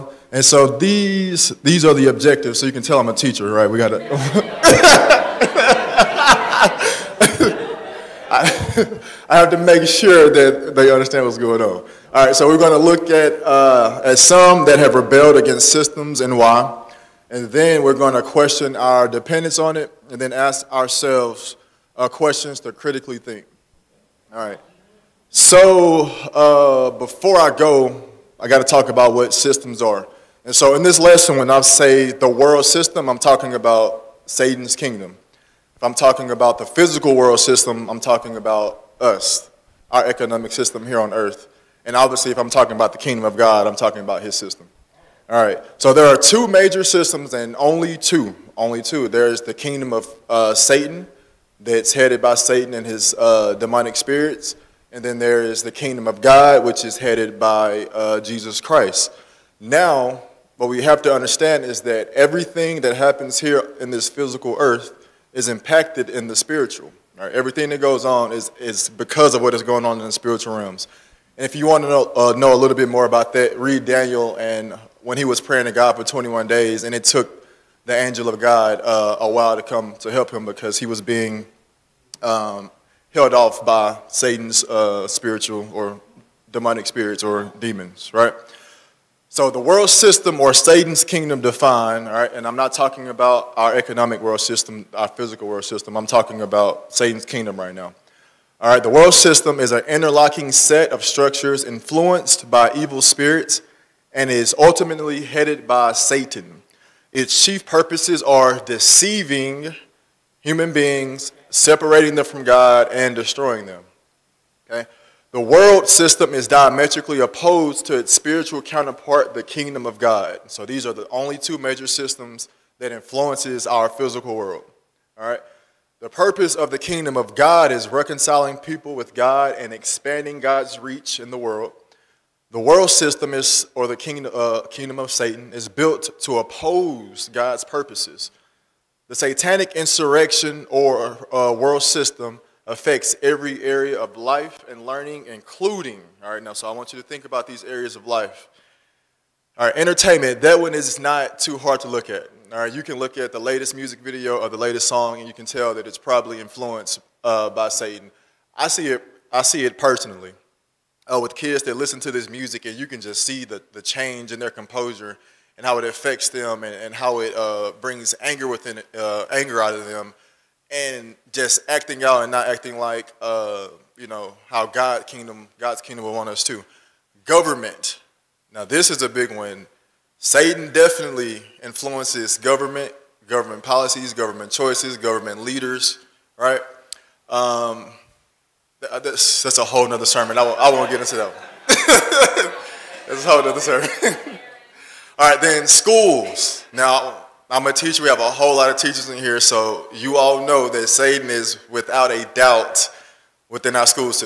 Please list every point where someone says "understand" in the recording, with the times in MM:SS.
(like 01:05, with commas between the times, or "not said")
00:10, 01:01.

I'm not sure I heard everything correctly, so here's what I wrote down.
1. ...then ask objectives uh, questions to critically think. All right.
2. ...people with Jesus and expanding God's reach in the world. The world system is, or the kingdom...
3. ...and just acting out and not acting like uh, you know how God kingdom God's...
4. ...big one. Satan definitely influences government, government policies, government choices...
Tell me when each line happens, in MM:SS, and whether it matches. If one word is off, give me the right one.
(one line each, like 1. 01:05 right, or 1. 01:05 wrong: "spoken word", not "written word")
1. 00:20 wrong: "ourselves", not "objectives"
2. 02:08 wrong: "God", not "Jesus"
3. 02:50 right
4. 02:59 right.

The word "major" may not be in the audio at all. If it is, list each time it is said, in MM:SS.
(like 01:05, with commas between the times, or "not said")
00:46, 02:01.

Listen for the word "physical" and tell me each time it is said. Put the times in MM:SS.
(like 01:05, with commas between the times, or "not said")
00:36, 01:04, 01:35, 02:03.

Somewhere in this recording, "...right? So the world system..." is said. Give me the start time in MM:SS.
01:28.